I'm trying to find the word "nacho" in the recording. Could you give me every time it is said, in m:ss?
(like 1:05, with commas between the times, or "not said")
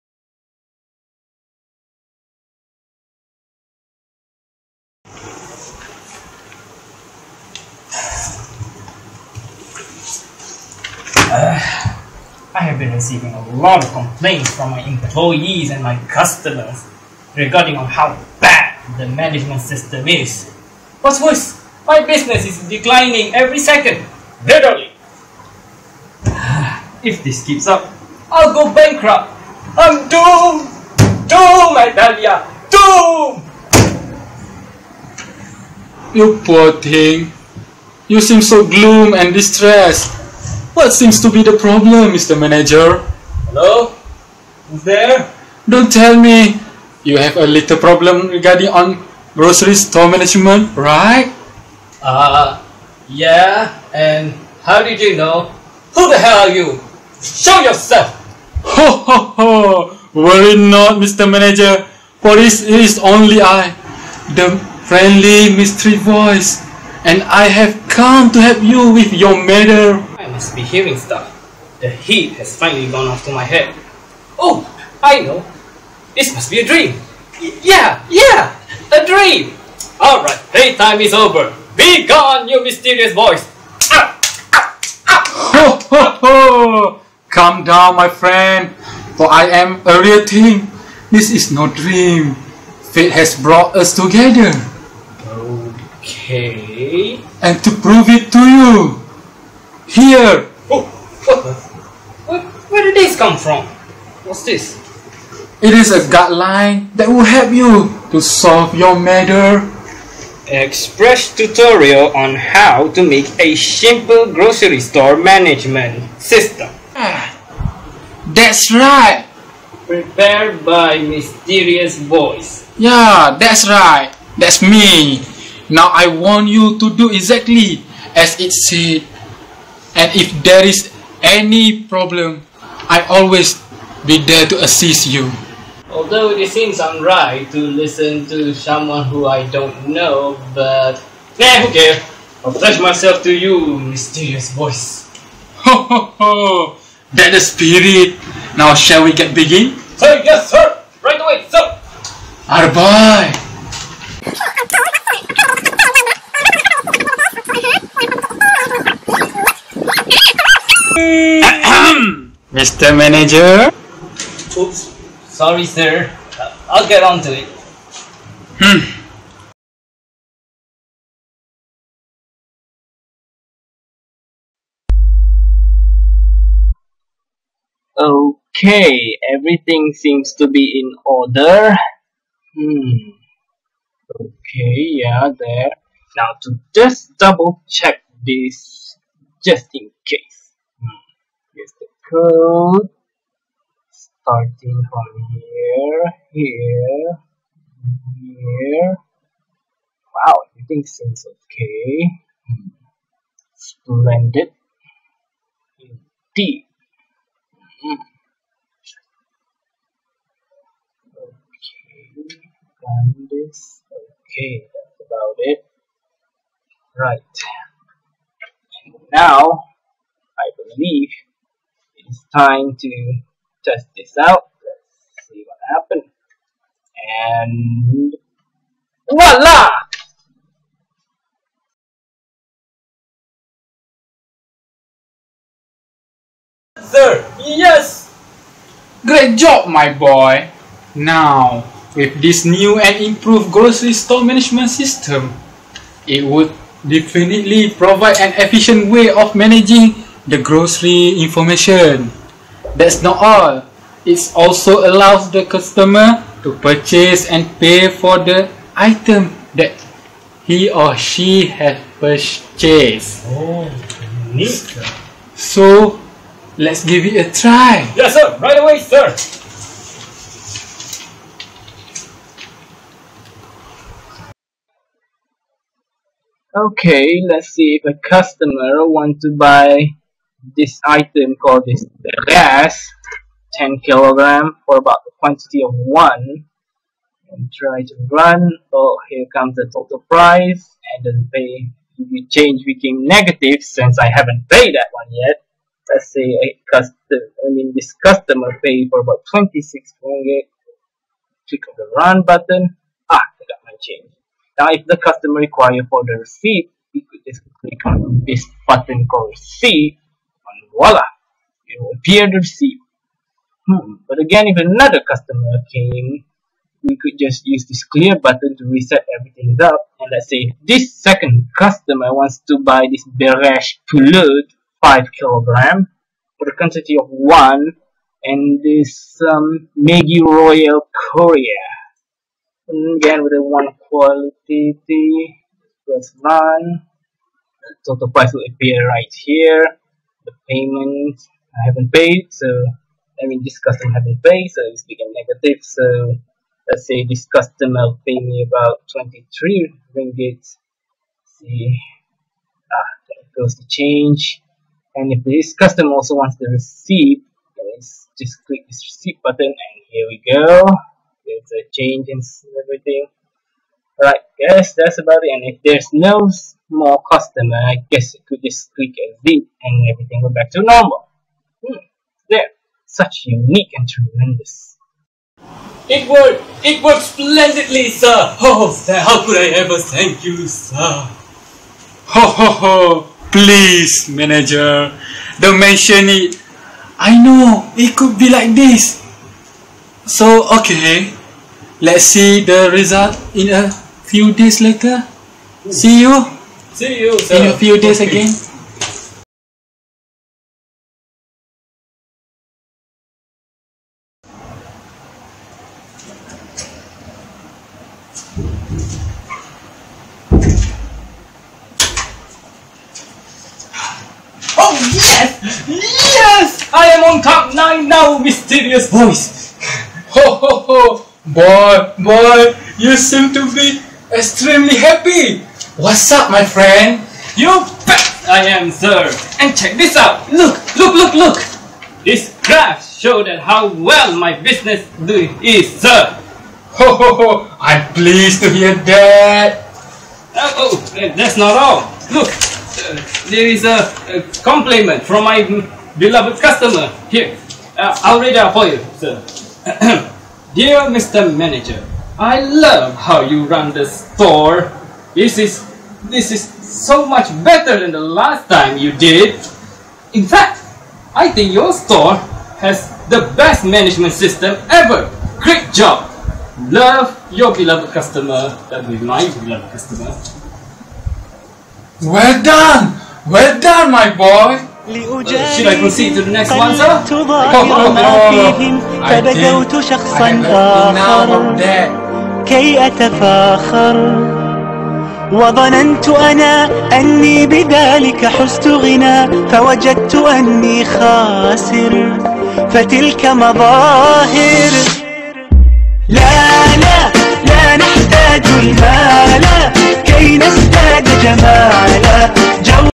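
not said.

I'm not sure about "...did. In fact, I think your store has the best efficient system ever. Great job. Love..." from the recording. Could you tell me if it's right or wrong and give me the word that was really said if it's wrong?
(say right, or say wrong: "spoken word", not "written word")
wrong: "management", not "efficient".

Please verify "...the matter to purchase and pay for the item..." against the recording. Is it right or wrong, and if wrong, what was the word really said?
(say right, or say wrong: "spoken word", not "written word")
wrong: "customer", not "matter".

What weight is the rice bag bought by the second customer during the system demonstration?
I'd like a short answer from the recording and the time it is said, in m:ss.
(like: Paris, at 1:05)
5 kilogram, at 5:24.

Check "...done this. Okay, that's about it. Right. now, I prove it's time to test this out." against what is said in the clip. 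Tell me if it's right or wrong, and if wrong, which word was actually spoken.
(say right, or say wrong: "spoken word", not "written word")
wrong: "believe", not "prove".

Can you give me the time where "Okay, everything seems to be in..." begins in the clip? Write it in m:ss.
2:57.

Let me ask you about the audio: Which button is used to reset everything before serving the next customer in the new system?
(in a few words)
clear.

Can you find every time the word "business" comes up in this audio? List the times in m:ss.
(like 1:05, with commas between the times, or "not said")
0:22, 7:14.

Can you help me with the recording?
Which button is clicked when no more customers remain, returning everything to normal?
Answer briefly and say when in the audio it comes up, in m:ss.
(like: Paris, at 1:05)
exit, at 6:08.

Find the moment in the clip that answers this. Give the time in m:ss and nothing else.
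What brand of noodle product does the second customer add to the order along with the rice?
5:29.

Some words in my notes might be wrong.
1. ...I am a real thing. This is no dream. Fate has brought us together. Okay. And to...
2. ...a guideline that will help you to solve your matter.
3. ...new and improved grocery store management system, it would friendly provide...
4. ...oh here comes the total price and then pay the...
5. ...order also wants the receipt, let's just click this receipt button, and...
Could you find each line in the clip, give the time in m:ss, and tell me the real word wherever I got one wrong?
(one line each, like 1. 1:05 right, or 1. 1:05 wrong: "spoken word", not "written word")
1. 1:29 right
2. 1:45 right
3. 4:02 wrong: "definitely", not "friendly"
4. 4:48 right
5. 5:55 wrong: "customer", not "order".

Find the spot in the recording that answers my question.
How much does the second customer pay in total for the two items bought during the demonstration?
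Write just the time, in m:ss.
5:48.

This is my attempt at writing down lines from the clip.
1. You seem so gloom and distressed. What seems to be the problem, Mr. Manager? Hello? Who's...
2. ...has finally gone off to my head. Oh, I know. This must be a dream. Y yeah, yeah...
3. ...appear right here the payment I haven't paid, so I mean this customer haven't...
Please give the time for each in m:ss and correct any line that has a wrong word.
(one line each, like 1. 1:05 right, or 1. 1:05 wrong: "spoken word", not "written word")
1. 0:38 right
2. 1:12 right
3. 5:38 right.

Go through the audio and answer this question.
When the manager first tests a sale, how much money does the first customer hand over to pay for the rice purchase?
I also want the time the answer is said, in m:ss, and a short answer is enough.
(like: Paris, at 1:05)
26 ringgit, at 4:59.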